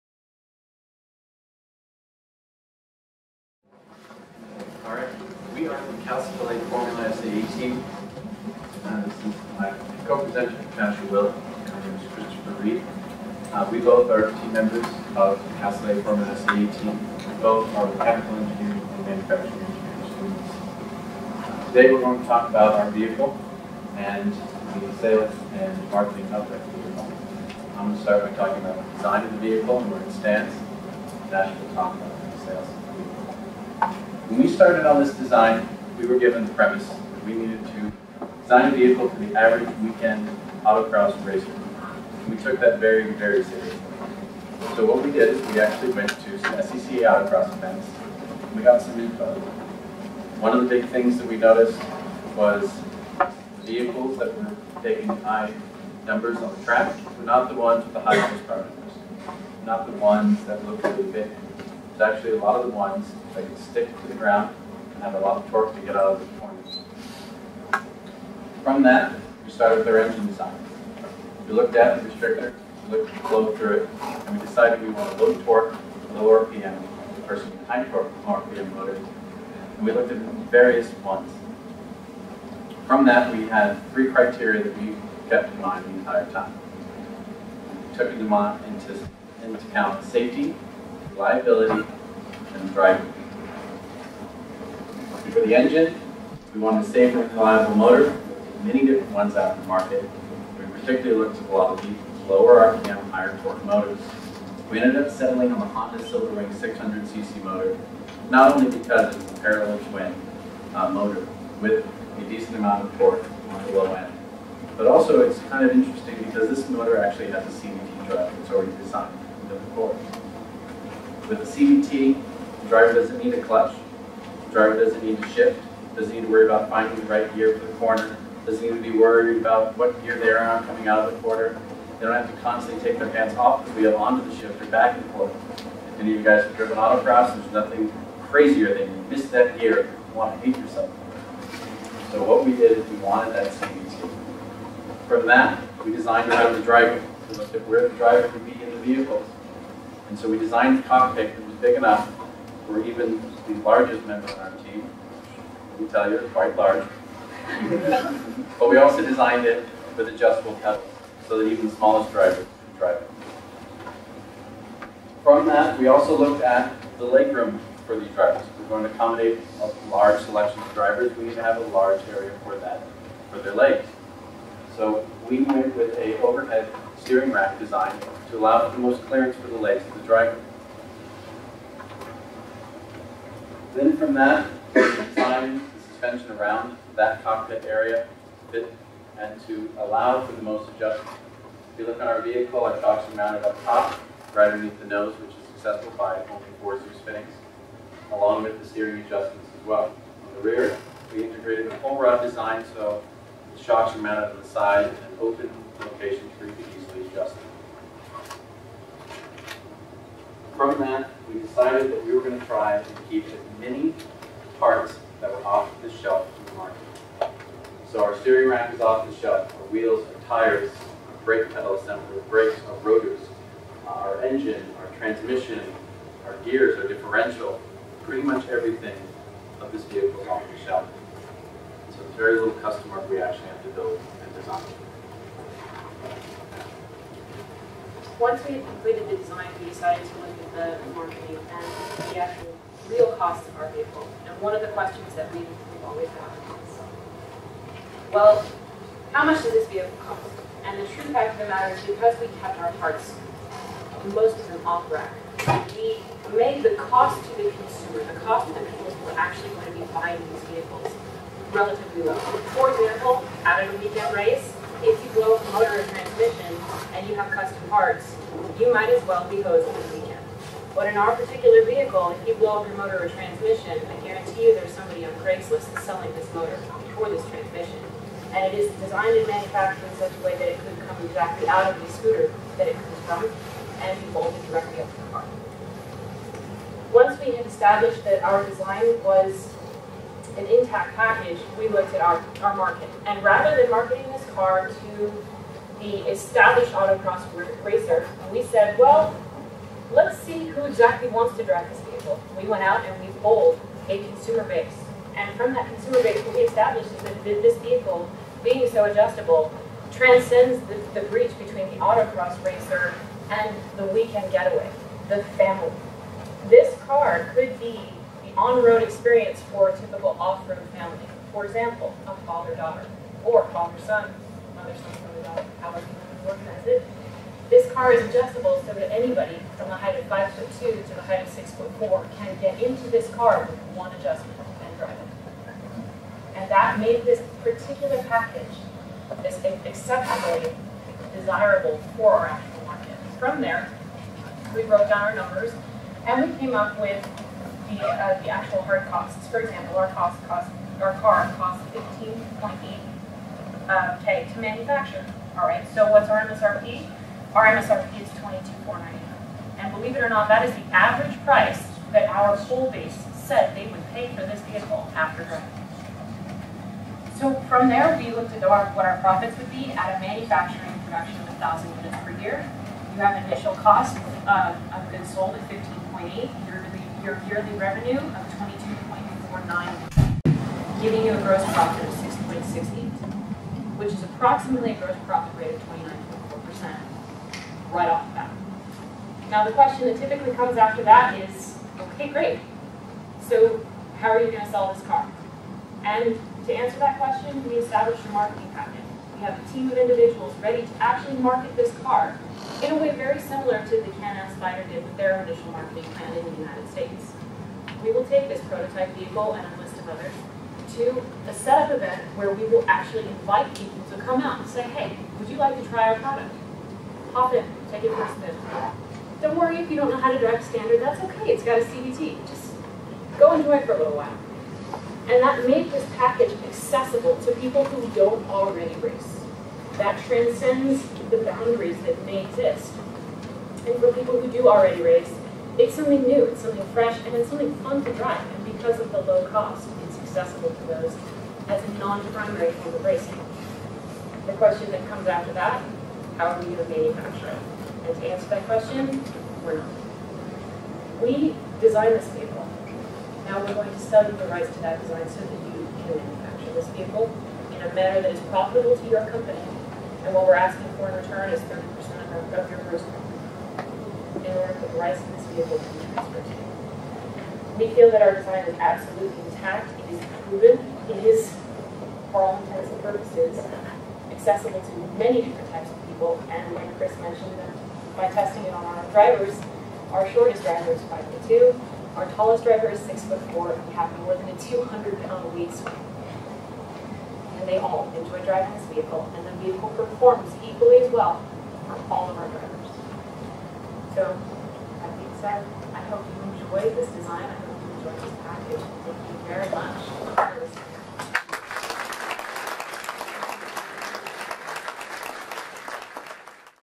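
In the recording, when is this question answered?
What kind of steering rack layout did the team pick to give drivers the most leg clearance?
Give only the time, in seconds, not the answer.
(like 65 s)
176 s.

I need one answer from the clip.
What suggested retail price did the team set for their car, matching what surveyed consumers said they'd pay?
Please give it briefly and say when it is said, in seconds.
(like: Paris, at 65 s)
$22,499, at 358 s.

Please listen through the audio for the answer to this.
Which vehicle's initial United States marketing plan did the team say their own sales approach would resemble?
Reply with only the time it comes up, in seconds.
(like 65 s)
403 s.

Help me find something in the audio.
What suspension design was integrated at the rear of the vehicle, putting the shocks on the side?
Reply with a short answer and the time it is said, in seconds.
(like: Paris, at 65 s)
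pull rod, at 201 s.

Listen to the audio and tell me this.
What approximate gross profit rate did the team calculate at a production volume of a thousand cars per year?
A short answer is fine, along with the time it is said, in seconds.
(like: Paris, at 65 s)
29.4%, at 385 s.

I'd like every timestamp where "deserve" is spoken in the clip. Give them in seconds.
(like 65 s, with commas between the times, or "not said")
not said.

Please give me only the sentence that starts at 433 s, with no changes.
And for people who do already race, it's something new, it's something fresh, and it's something fun to drive.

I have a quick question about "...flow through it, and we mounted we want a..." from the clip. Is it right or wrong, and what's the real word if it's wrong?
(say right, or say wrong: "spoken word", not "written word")
wrong: "decided", not "mounted".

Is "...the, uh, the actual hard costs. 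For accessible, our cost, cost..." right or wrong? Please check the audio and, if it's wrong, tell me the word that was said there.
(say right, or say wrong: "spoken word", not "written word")
wrong: "example", not "accessible".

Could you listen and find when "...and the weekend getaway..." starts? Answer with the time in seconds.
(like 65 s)
313 s.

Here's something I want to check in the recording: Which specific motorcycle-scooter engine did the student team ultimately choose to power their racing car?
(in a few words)
Honda Silverwing 600cc.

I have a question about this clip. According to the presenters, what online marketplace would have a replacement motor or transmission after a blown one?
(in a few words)
Craigslist.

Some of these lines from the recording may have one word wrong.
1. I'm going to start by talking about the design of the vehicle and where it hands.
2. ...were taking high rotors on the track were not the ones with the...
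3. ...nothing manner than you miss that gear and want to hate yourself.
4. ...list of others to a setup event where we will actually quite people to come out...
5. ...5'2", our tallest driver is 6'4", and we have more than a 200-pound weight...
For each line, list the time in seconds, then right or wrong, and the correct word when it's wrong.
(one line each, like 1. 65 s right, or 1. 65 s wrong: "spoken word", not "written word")
1. 27 s wrong: "stands", not "hands"
2. 54 s wrong: "numbers", not "rotors"
3. 137 s wrong: "crazier", not "manner"
4. 409 s wrong: "invite", not "quite"
5. 480 s right.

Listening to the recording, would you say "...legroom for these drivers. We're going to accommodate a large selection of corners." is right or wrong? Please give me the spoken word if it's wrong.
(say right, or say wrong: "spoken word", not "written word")
wrong: "drivers", not "corners".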